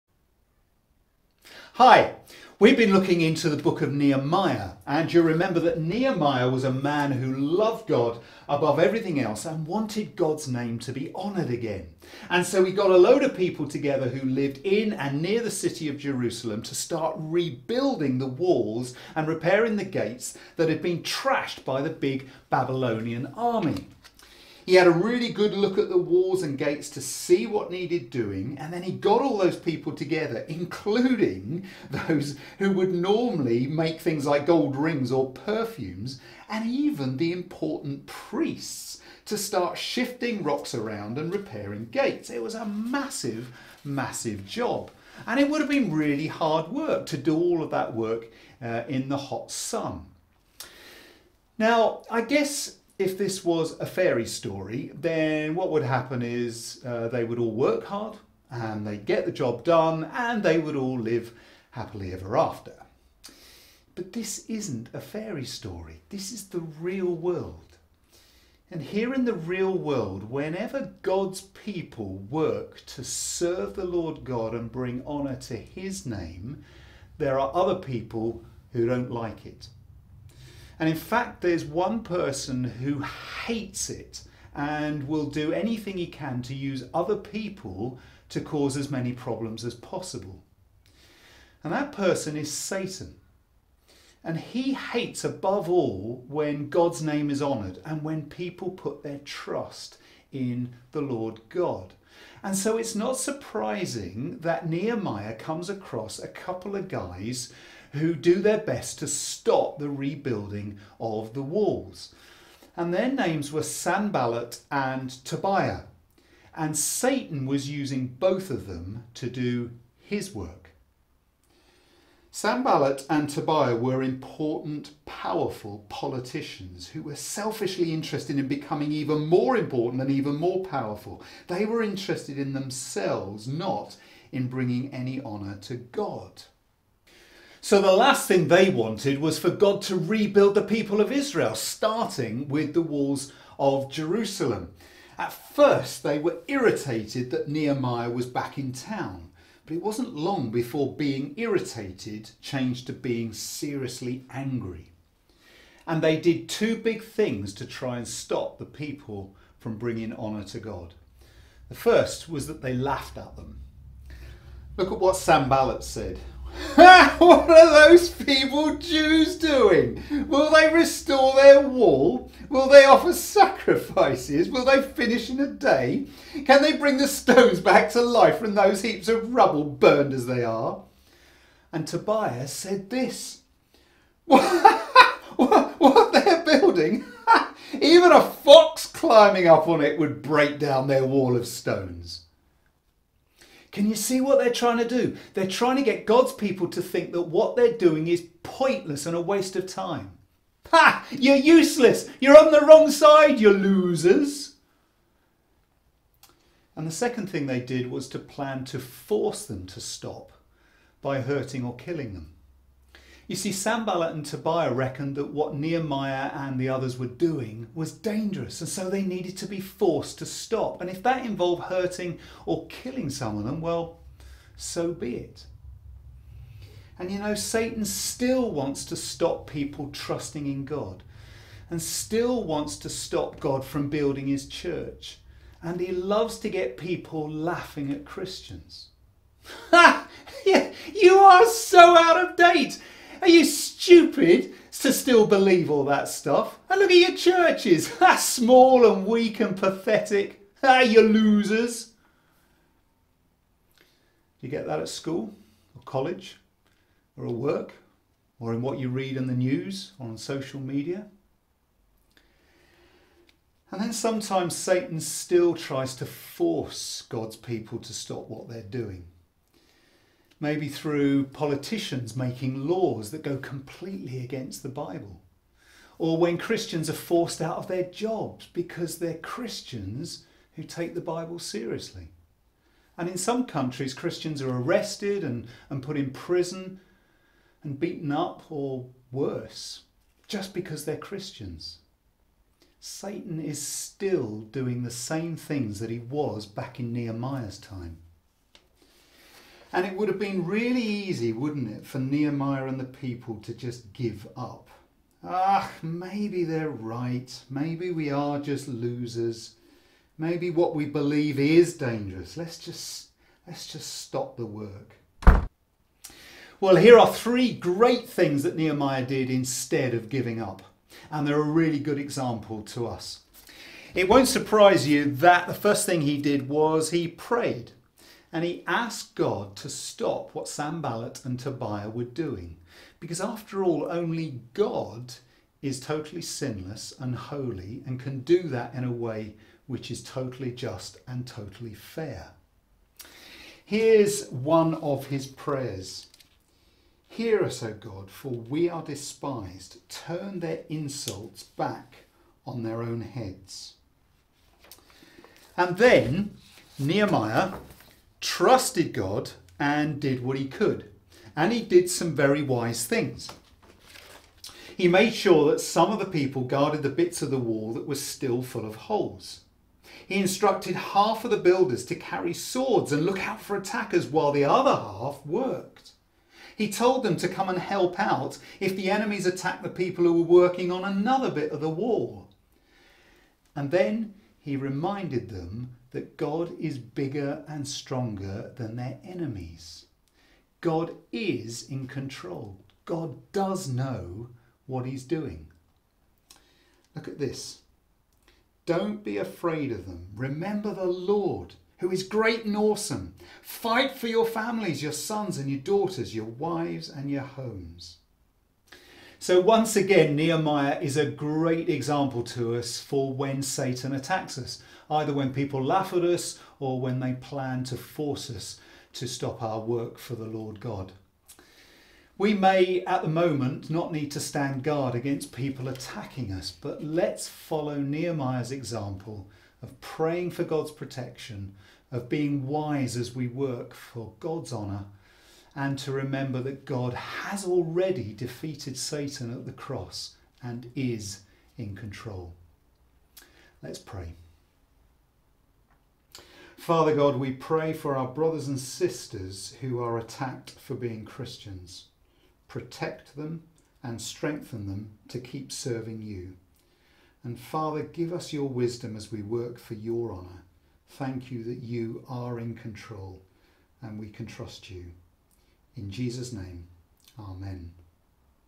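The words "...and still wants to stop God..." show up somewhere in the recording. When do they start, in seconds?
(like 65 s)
231 s.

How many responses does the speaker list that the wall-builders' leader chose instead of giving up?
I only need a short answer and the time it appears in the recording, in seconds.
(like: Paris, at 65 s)
3, at 317 s.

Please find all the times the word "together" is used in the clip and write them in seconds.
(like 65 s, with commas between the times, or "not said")
13 s, 29 s.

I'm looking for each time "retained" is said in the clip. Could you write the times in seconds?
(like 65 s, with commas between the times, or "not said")
not said.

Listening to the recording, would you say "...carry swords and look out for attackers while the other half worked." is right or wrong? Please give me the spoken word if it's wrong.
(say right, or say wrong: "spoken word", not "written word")
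right.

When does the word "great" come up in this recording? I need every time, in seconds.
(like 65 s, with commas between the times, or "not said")
317 s, 402 s, 411 s.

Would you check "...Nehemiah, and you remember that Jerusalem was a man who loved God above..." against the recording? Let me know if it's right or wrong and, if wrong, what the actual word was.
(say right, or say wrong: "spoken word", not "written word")
wrong: "Nehemiah", not "Jerusalem".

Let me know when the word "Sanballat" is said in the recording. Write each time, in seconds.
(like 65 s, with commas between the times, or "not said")
113 s, 122 s, 165 s, 213 s, 330 s.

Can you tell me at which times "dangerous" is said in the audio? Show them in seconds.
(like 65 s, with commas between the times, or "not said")
217 s, 311 s.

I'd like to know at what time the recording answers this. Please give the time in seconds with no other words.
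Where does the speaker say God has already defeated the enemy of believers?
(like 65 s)
439 s.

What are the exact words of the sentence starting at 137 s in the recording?
So the last thing they wanted was for God to rebuild the people of Israel, starting with the walls of Jerusalem.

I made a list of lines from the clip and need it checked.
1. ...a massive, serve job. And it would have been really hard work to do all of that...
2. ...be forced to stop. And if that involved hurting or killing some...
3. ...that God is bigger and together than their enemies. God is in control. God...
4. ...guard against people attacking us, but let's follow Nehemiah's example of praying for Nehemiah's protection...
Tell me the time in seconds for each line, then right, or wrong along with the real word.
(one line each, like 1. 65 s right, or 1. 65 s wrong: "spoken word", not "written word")
1. 42 s wrong: "massive", not "serve"
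2. 219 s right
3. 385 s wrong: "stronger", not "together"
4. 424 s wrong: "God", not "Nehemiah".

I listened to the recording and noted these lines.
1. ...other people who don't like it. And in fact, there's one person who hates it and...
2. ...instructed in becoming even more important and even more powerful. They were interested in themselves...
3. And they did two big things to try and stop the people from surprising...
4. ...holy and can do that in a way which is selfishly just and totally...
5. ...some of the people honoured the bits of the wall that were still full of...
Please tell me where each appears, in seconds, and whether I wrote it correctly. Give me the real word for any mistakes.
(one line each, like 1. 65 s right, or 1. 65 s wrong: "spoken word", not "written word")
1. 77 s right
2. 127 s wrong: "interested", not "instructed"
3. 155 s wrong: "bringing", not "surprising"
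4. 337 s wrong: "totally", not "selfishly"
5. 365 s wrong: "guarded", not "honoured".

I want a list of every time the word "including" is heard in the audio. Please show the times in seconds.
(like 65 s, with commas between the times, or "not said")
30 s.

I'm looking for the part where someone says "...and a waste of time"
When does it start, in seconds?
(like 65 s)
199 s.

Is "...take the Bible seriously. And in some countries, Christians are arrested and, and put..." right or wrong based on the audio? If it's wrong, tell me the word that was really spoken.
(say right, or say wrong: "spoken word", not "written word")
right.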